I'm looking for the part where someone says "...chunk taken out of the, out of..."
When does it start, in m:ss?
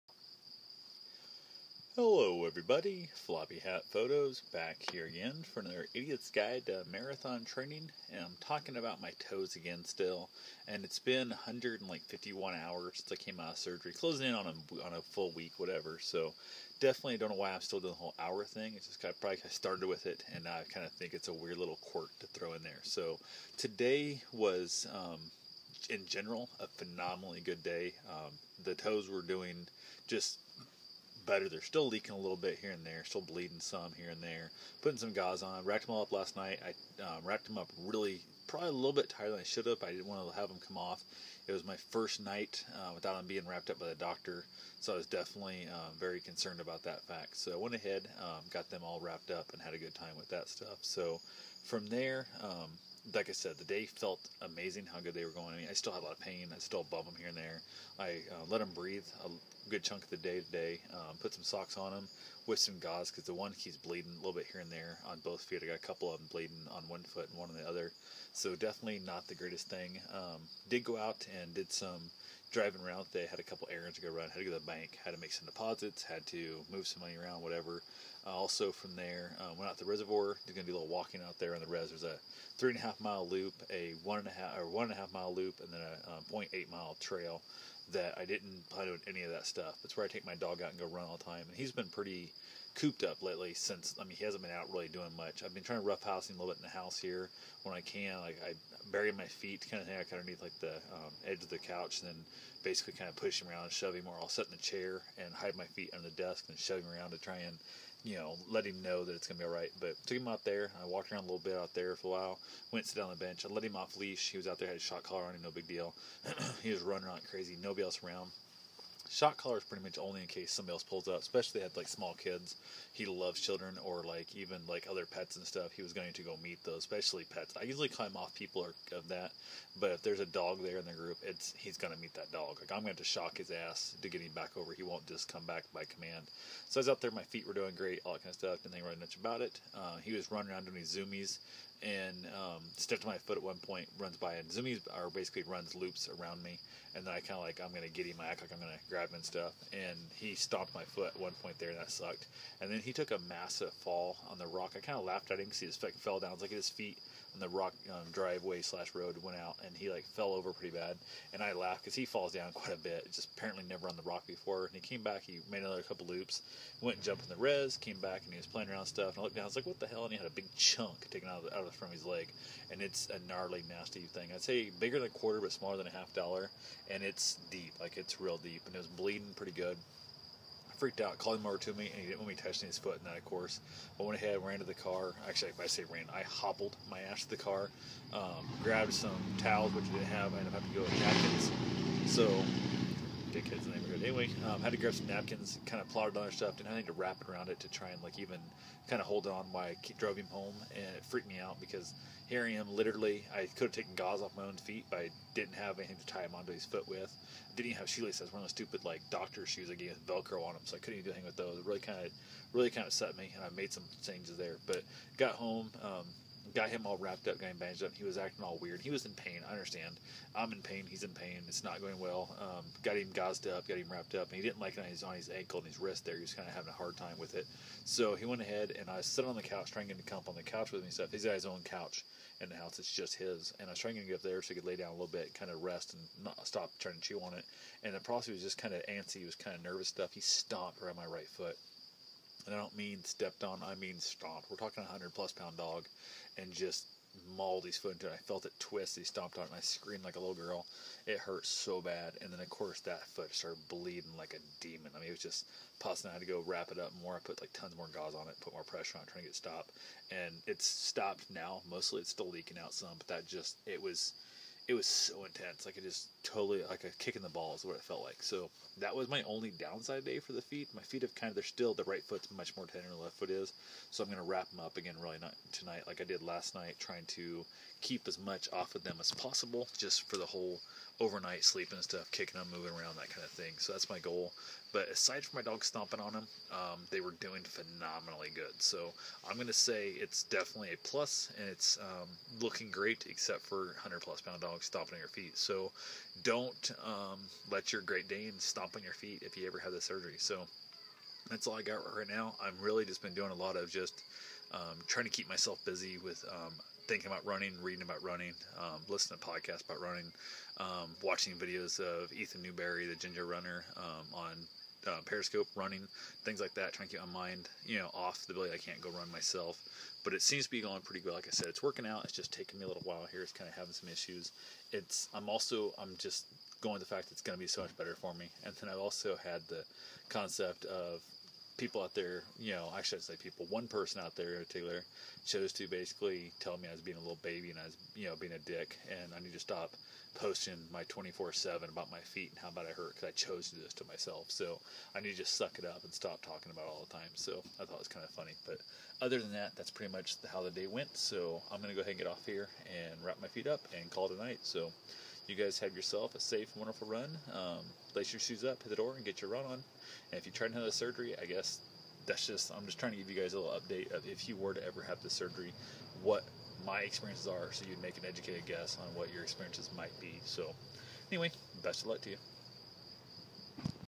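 2:50.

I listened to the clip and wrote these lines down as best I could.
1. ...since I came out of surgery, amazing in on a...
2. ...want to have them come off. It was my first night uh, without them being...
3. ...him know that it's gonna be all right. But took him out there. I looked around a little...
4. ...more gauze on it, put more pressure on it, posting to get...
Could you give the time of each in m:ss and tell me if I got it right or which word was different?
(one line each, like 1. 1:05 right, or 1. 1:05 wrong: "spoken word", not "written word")
1. 0:13 wrong: "closing", not "amazing"
2. 0:40 right
3. 1:48 wrong: "walked", not "looked"
4. 4:17 wrong: "trying", not "posting".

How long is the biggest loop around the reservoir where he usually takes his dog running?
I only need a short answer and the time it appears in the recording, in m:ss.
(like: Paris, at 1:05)
3.5 miles, at 1:22.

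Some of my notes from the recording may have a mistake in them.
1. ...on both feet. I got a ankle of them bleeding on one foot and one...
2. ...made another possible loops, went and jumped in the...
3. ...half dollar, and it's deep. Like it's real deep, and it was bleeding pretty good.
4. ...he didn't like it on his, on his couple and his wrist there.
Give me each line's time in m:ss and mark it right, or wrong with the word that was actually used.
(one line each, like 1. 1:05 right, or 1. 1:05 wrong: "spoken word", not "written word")
1. 1:05 wrong: "couple", not "ankle"
2. 2:45 wrong: "couple", not "possible"
3. 2:55 right
4. 3:44 wrong: "ankle", not "couple".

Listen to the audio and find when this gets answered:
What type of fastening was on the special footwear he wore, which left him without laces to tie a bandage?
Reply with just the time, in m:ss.
3:30.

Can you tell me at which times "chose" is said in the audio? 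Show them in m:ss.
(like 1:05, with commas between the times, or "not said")
5:35, 5:43.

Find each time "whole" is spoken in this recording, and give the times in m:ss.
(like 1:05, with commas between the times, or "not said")
0:17, 4:40.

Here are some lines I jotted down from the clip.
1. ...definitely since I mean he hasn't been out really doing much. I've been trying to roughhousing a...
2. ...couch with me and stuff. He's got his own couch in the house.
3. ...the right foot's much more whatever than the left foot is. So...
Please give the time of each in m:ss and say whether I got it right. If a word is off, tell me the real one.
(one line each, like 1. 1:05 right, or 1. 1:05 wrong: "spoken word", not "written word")
1. 1:33 wrong: "lately", not "definitely"
2. 3:50 right
3. 4:31 wrong: "tender", not "whatever".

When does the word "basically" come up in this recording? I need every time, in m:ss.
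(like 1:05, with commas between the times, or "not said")
1:42, 2:25, 5:35.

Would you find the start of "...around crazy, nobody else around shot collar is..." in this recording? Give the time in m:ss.
1:57.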